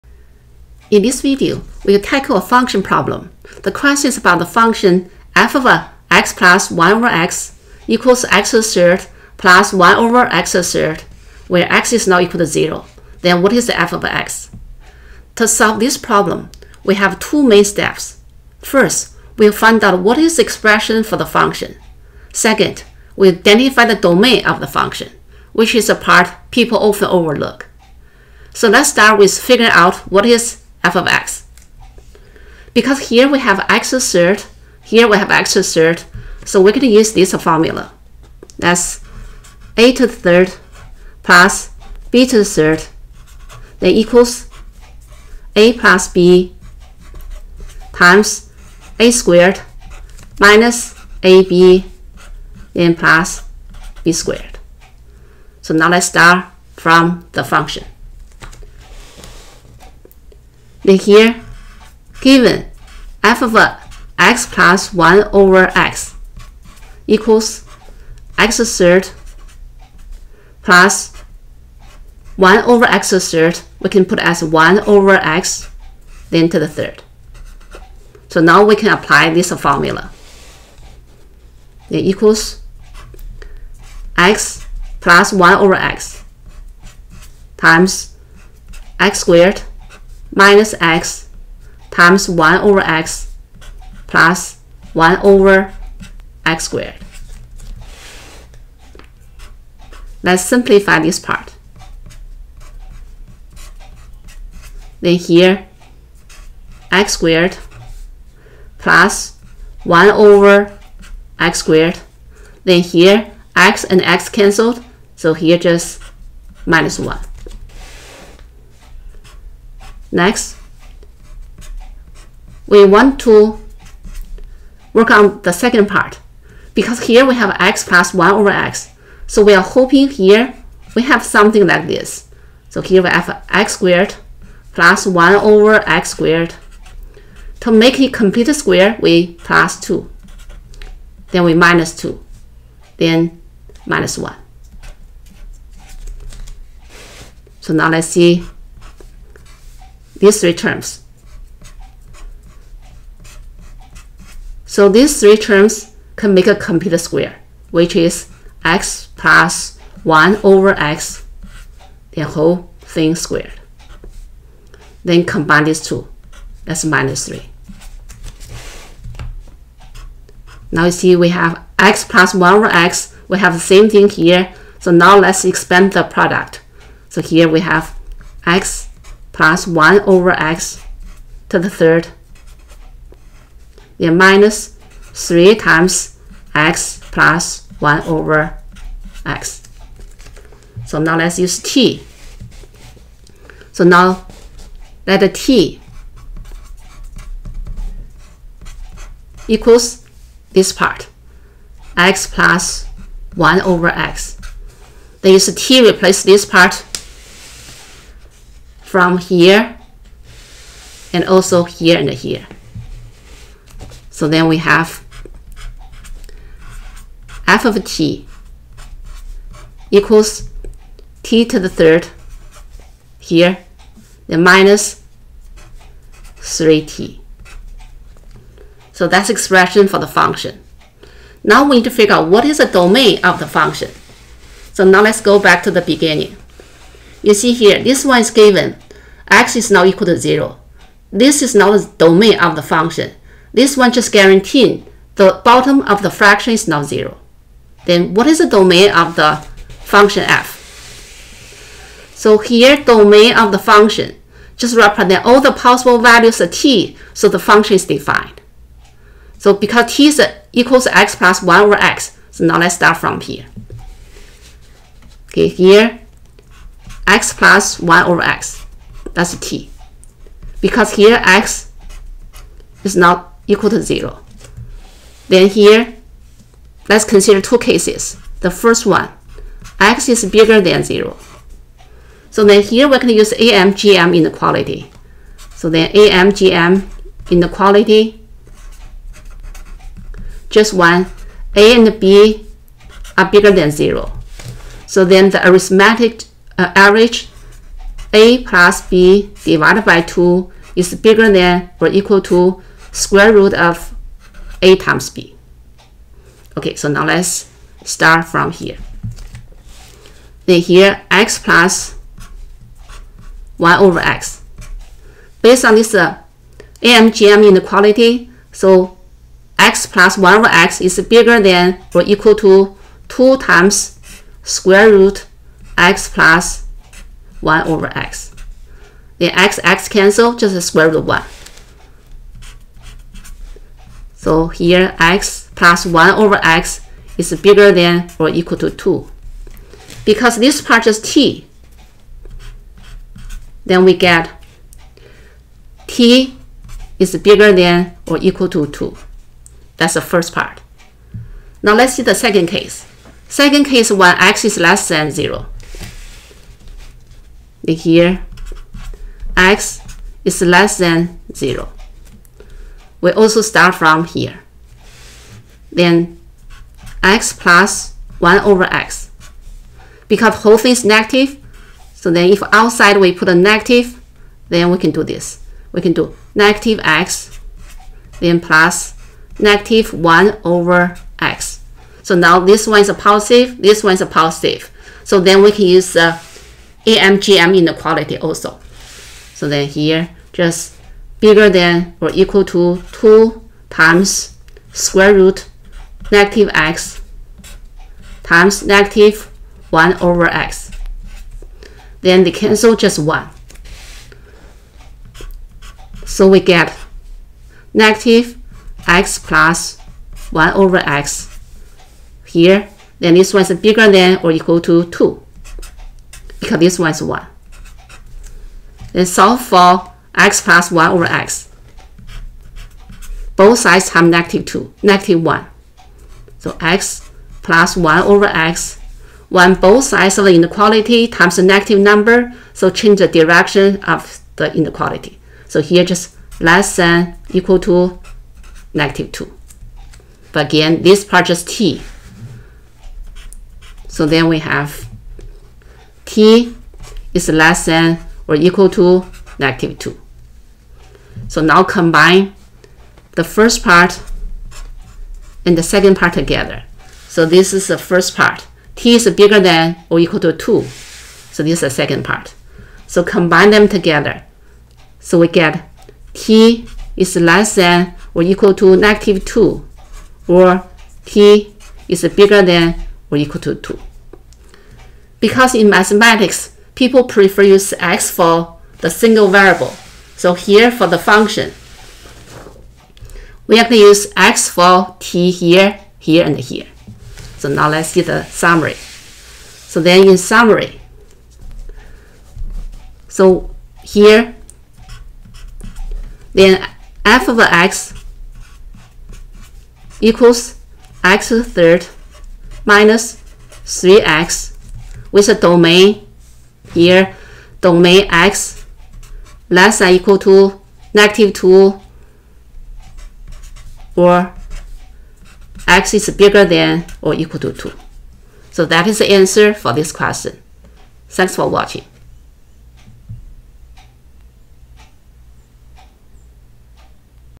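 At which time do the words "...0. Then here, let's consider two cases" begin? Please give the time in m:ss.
4:33.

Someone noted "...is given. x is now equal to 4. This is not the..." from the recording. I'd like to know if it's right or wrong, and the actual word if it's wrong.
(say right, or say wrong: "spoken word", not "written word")
wrong: "0", not "4".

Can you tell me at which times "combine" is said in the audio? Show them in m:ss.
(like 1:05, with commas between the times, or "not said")
2:45, 7:31, 7:43.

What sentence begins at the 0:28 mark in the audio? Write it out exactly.
So let's start with figuring out what is f of x.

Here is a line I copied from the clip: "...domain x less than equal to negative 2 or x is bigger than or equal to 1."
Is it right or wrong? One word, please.
wrong.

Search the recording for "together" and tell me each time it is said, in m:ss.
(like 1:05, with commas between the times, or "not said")
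7:36, 7:43.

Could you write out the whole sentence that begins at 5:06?
Okay, so now let's start from here.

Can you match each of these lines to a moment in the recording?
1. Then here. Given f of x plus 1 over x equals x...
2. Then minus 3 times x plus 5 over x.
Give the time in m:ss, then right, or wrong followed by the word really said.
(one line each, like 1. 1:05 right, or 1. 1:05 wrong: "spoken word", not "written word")
1. 1:00 right
2. 3:03 wrong: "1", not "5".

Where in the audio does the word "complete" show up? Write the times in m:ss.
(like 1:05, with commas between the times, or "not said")
2:18, 2:36.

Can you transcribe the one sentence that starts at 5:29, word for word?
the x, x cancel, just square root of 1.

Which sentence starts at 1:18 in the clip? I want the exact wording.
So now we can apply this formula.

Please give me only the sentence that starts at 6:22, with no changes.
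So now this one is a positive, this one is a positive.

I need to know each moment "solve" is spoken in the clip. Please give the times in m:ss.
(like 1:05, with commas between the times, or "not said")
0:15, 6:59.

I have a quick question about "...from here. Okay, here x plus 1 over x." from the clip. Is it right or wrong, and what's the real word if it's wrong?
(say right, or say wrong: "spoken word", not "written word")
right.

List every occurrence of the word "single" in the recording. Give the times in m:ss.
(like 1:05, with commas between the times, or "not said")
7:58.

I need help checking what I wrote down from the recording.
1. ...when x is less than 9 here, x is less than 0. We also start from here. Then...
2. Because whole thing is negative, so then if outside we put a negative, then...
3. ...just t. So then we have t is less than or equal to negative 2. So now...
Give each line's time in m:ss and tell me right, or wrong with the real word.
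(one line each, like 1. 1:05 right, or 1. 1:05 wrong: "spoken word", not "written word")
1. 5:53 wrong: "0", not "9"
2. 6:10 right
3. 7:21 right.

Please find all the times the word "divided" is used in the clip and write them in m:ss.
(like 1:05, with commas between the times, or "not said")
4:59.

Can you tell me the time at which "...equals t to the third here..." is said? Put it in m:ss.
3:39.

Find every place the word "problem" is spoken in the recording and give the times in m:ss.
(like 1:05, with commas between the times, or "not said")
0:02, 0:15.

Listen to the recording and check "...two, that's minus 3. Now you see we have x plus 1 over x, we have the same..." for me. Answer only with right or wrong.
right.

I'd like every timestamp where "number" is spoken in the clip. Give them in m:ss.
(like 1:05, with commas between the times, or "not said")
7:11.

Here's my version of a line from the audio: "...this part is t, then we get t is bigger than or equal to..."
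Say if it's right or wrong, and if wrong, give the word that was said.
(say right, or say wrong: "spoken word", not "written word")
right.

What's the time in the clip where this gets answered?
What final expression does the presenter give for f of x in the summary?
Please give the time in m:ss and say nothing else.
8:21.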